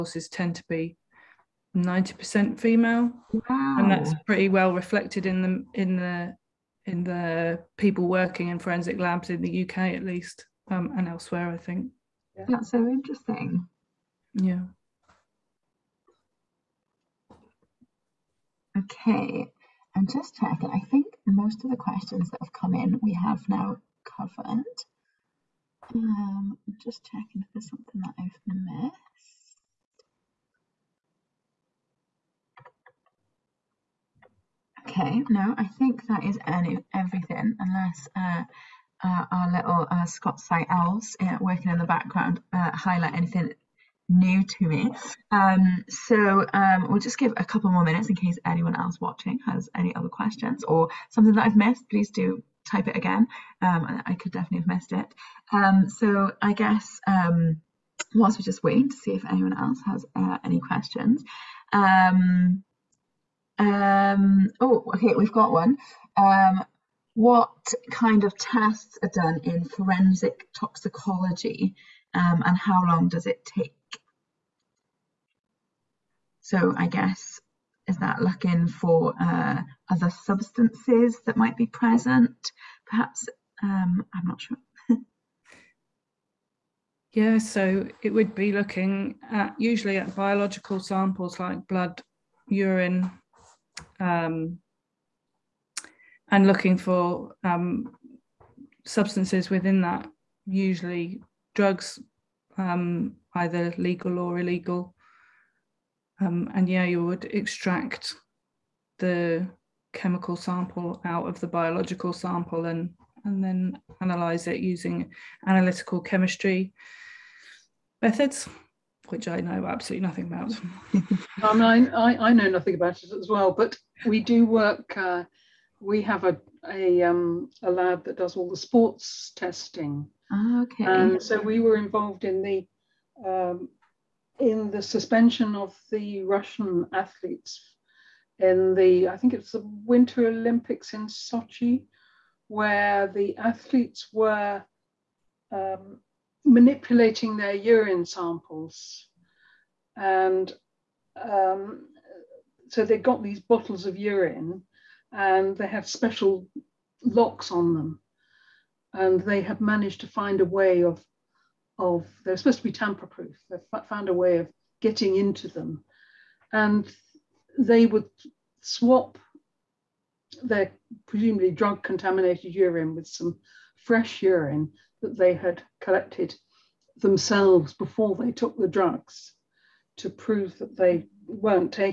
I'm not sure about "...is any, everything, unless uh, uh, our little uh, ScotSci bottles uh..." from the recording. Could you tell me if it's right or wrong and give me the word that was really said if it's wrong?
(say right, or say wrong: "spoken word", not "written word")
wrong: "elves", not "bottles".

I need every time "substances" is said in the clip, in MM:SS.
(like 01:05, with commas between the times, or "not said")
01:20, 01:38.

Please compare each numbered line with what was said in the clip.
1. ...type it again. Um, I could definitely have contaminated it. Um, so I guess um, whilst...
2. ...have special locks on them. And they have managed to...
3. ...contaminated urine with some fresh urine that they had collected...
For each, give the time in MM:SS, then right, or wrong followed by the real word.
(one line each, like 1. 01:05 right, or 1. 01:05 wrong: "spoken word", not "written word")
1. 00:52 wrong: "missed", not "contaminated"
2. 02:35 right
3. 02:51 right.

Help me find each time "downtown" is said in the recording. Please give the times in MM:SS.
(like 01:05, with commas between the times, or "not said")
not said.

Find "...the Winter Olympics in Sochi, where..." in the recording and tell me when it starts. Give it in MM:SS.
02:19.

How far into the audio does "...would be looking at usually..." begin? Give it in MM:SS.
01:28.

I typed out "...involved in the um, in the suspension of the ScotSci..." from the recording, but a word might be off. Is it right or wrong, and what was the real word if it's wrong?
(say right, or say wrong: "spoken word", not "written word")
wrong: "Russian", not "ScotSci".